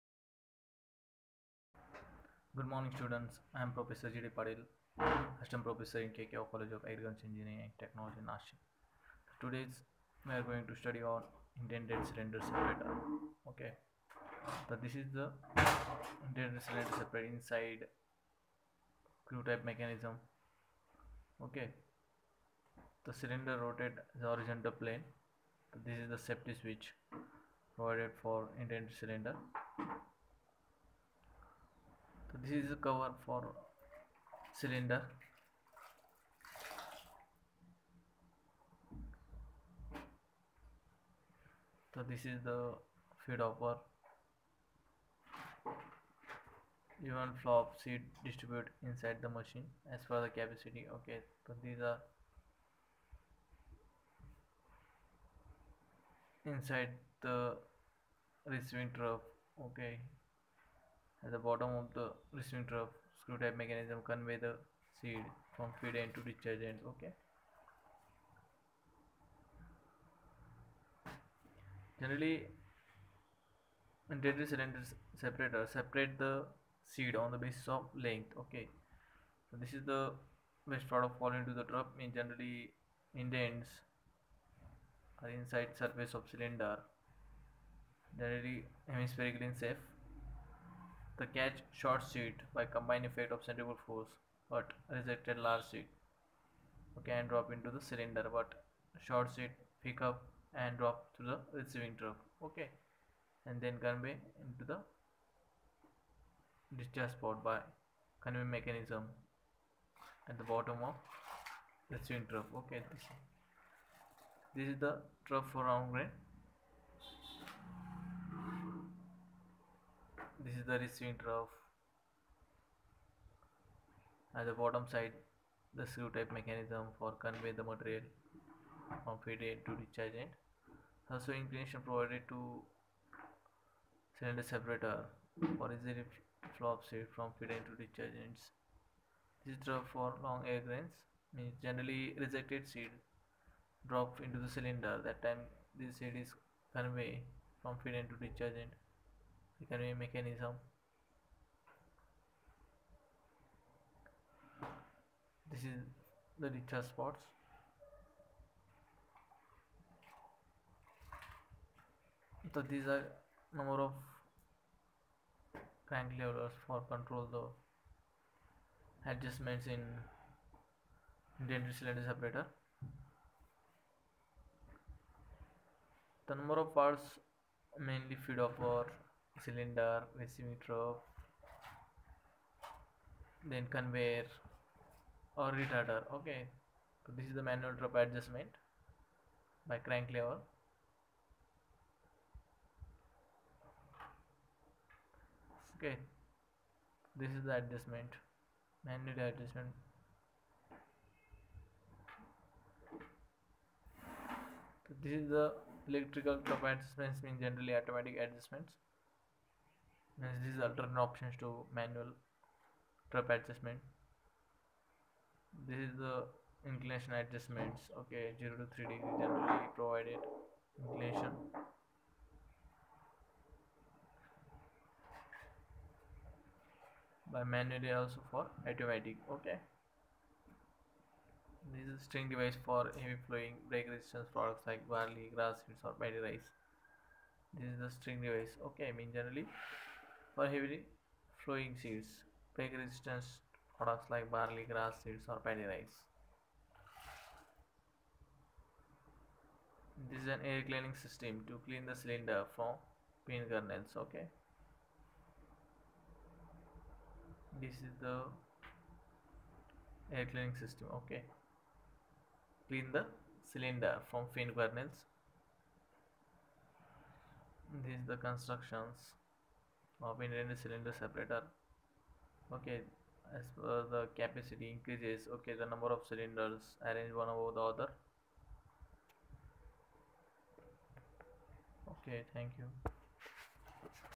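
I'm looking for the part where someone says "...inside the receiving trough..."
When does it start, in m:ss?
0:56.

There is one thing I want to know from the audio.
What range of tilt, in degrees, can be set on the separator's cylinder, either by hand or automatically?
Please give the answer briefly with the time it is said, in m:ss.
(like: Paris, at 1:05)
0 to 3 degrees, at 3:38.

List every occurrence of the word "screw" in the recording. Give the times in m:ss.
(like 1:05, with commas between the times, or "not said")
0:19, 1:03, 2:05.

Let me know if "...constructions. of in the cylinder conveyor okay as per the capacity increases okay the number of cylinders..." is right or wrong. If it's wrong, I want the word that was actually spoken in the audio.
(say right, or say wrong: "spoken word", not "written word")
wrong: "separator", not "conveyor".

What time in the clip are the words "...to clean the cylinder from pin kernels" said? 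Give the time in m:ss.
4:11.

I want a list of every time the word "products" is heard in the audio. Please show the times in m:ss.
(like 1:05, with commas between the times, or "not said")
1:20, 3:54, 4:03.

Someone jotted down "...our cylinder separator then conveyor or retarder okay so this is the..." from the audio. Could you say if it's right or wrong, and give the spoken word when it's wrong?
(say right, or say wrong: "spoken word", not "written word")
wrong: "reciprocator", not "separator".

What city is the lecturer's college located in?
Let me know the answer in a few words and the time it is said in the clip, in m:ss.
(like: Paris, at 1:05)
Nashik, at 0:08.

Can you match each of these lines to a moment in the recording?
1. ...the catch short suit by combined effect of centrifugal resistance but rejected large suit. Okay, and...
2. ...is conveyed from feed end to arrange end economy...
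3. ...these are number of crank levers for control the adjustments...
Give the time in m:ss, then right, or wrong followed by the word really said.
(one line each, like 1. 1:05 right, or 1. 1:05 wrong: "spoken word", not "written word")
1. 1:31 wrong: "force", not "resistance"
2. 2:26 wrong: "discharge", not "arrange"
3. 2:42 right.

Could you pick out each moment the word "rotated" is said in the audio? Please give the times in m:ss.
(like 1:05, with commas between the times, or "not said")
0:23.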